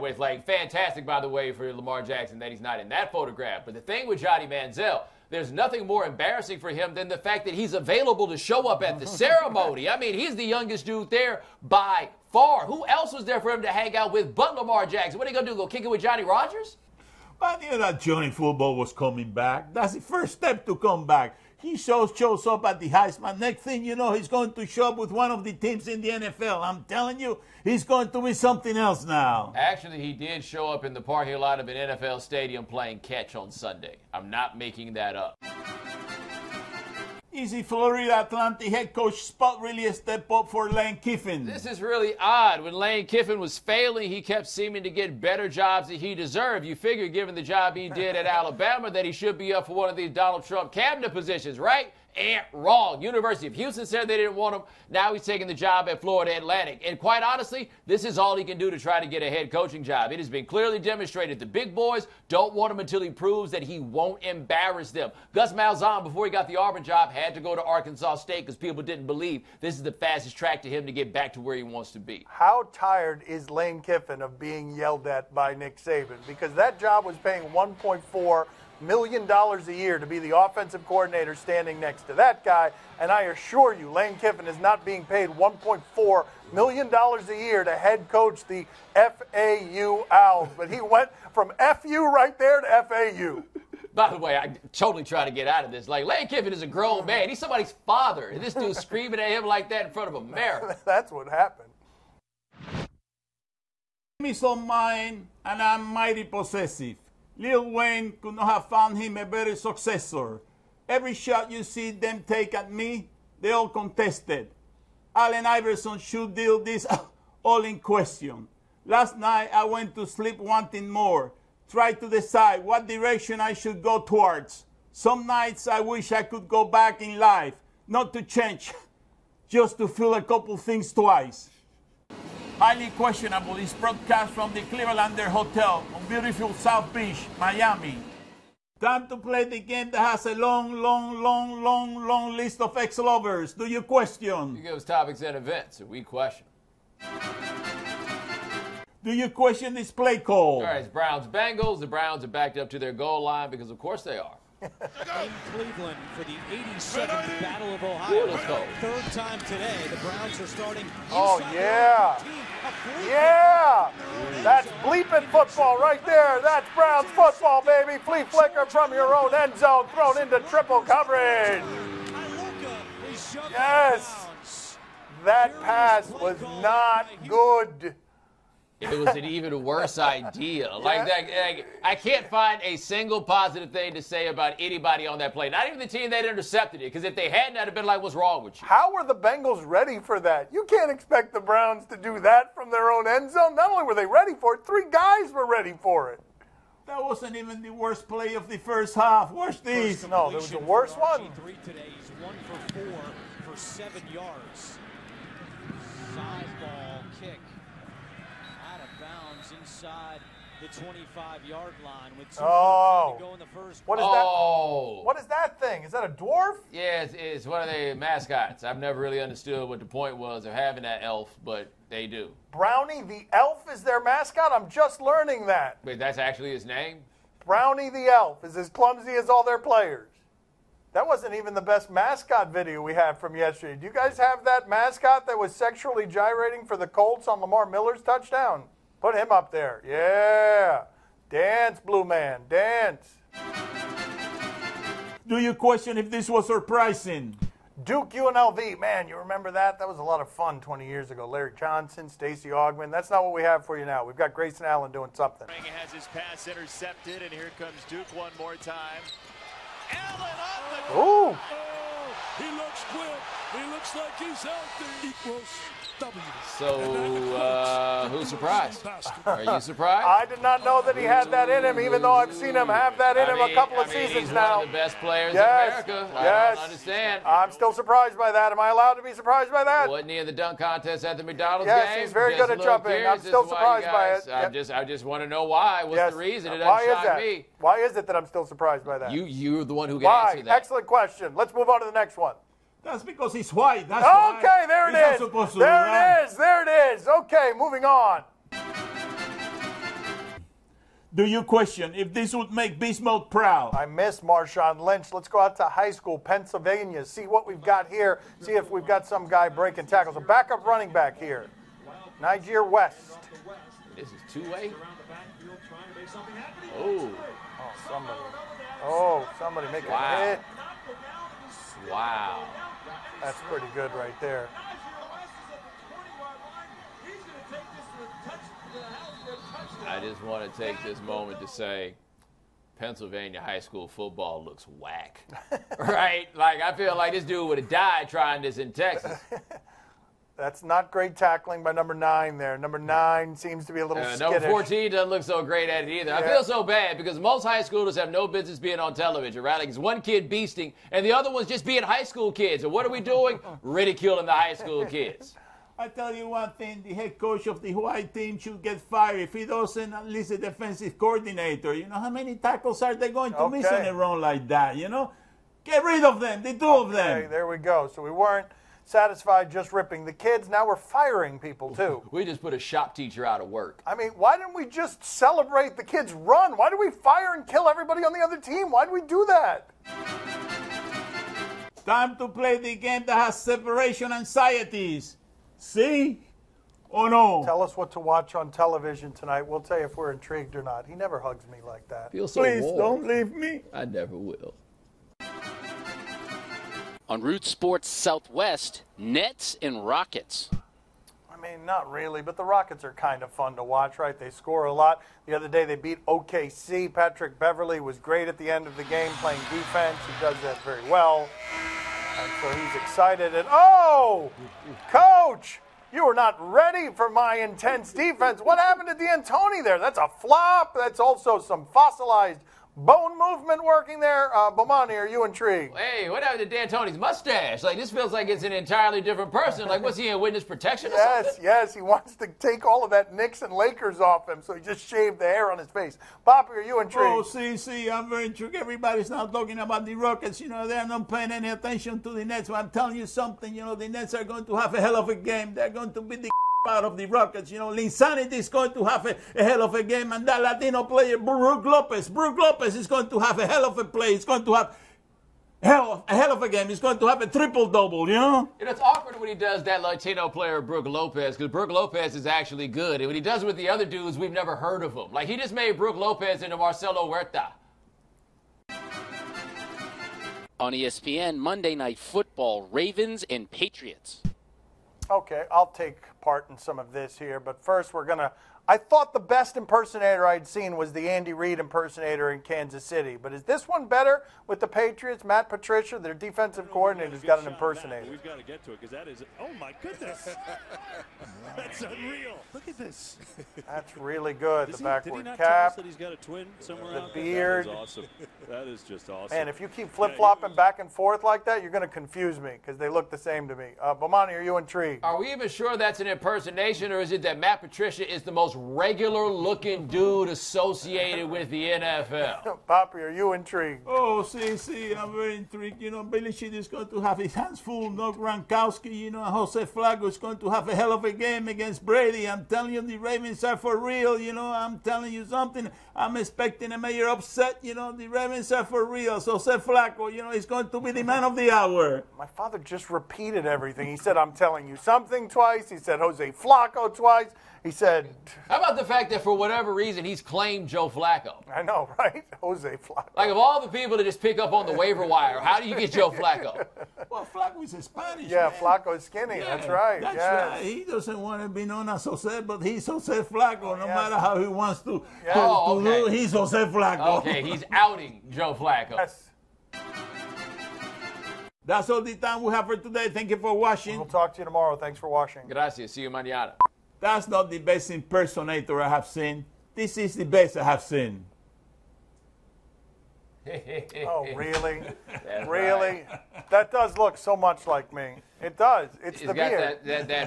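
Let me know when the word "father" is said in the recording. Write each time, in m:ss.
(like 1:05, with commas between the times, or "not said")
1:37, 8:52.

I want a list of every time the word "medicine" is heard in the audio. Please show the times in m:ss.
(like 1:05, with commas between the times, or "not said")
not said.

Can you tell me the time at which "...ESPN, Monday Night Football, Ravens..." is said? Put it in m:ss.
7:50.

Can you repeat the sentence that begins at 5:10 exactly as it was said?
A backup running back here, Niger West.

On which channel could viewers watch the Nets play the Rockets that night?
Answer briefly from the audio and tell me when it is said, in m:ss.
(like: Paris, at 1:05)
Root Sports Southwest, at 6:37.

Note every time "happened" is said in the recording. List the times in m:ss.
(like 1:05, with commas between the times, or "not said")
1:41, 6:58, 7:06.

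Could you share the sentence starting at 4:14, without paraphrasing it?
We've got Grayson Allen doing something.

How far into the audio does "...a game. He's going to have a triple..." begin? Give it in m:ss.
7:36.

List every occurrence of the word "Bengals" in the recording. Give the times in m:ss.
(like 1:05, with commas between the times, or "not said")
2:31, 3:09.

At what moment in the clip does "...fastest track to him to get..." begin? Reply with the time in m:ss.
1:09.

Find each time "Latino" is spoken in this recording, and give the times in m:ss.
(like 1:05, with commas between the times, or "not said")
7:30, 7:39.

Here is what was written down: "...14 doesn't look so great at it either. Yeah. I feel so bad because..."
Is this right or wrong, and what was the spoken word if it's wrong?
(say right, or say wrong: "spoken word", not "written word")
right.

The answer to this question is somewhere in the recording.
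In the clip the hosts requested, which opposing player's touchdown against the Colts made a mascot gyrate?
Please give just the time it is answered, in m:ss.
3:57.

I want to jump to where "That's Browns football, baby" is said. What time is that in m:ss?
2:46.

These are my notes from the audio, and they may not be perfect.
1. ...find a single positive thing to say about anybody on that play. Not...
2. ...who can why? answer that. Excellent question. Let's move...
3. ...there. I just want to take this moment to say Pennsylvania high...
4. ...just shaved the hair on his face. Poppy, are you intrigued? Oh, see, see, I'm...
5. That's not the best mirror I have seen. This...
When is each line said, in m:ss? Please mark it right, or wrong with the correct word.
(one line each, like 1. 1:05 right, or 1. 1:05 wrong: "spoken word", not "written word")
1. 3:02 right
2. 4:49 right
3. 5:24 right
4. 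7:14 right
5. 9:26 wrong: "impersonator", not "mirror".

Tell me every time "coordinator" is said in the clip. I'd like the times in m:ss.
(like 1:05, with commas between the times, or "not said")
1:20, 6:00, 8:06.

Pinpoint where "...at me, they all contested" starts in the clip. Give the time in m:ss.
1:52.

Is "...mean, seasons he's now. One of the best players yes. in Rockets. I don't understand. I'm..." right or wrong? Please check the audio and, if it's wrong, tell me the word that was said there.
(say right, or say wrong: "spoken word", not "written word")
wrong: "America", not "Rockets".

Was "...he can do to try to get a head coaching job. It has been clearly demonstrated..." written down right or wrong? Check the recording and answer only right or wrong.
right.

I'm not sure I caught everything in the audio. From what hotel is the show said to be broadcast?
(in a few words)
Clevelander Hotel.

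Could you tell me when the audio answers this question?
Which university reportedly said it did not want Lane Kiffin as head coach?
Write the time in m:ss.
0:53.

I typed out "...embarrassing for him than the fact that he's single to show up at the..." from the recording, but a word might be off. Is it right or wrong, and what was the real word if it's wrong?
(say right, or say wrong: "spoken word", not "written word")
wrong: "available", not "single".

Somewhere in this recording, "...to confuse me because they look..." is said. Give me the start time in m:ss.
8:21.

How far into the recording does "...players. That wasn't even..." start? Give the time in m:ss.
3:49.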